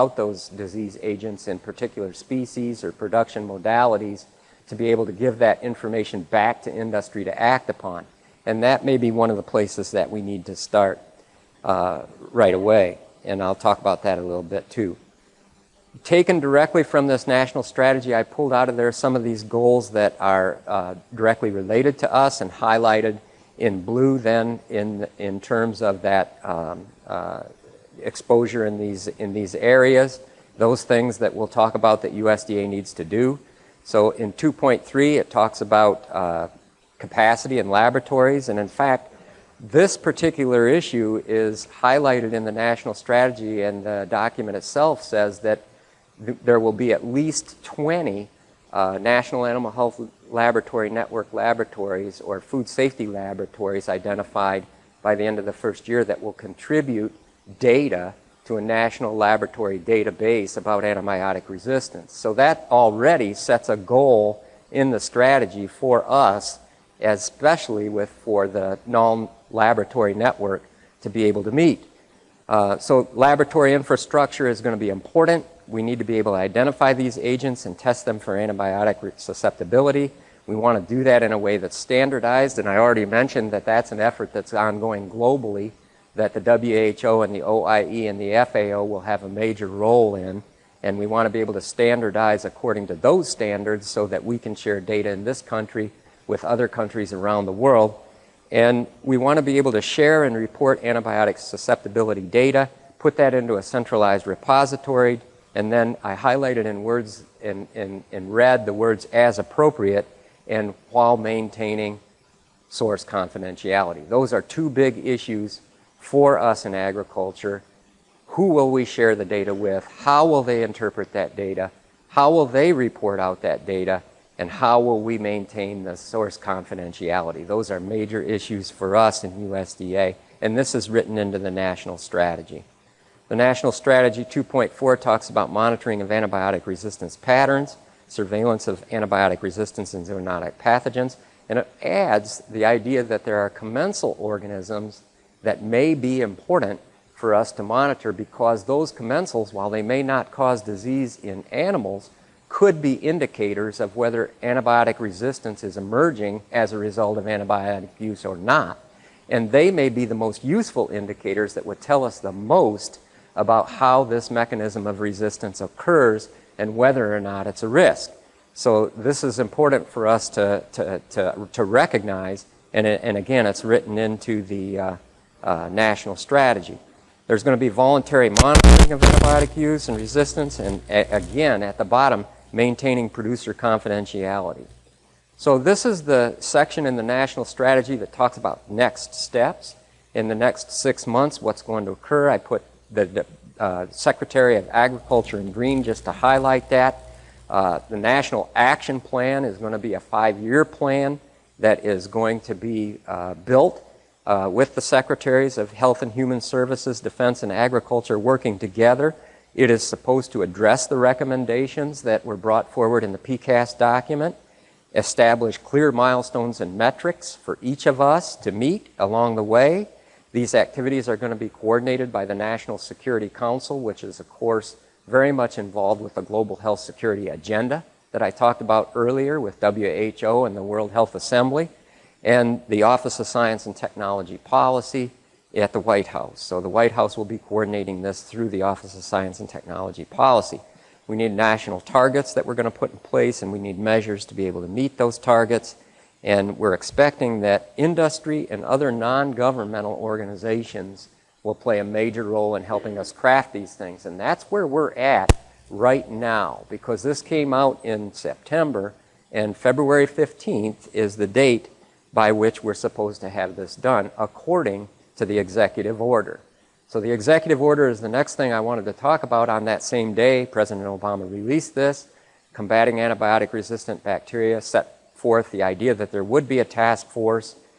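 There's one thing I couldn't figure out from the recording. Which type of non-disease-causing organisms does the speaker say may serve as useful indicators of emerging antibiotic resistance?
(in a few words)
Commensal organisms.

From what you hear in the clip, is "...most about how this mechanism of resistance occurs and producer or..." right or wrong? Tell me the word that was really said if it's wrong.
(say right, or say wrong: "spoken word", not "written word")
wrong: "whether", not "producer".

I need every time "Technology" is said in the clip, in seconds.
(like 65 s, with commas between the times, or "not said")
233 s, 239 s.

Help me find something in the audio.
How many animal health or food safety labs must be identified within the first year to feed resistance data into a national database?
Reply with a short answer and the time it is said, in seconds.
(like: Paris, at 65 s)
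20, at 47 s.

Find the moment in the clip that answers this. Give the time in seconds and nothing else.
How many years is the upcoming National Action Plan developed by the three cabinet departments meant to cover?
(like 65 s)
199 s.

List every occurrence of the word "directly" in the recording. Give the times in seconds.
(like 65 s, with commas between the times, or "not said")
16 s, 21 s.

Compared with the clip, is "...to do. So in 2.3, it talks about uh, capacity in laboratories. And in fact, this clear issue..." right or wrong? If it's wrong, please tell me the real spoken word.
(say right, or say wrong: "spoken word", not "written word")
wrong: "particular", not "clear".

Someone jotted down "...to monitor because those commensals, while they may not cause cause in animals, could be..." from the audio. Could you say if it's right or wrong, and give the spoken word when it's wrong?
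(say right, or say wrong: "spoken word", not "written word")
wrong: "disease", not "cause".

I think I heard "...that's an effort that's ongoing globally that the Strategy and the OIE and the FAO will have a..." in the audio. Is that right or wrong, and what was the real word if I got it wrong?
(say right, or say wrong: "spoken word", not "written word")
wrong: "WHO", not "Strategy".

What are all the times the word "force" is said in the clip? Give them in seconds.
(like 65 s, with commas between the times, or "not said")
277 s.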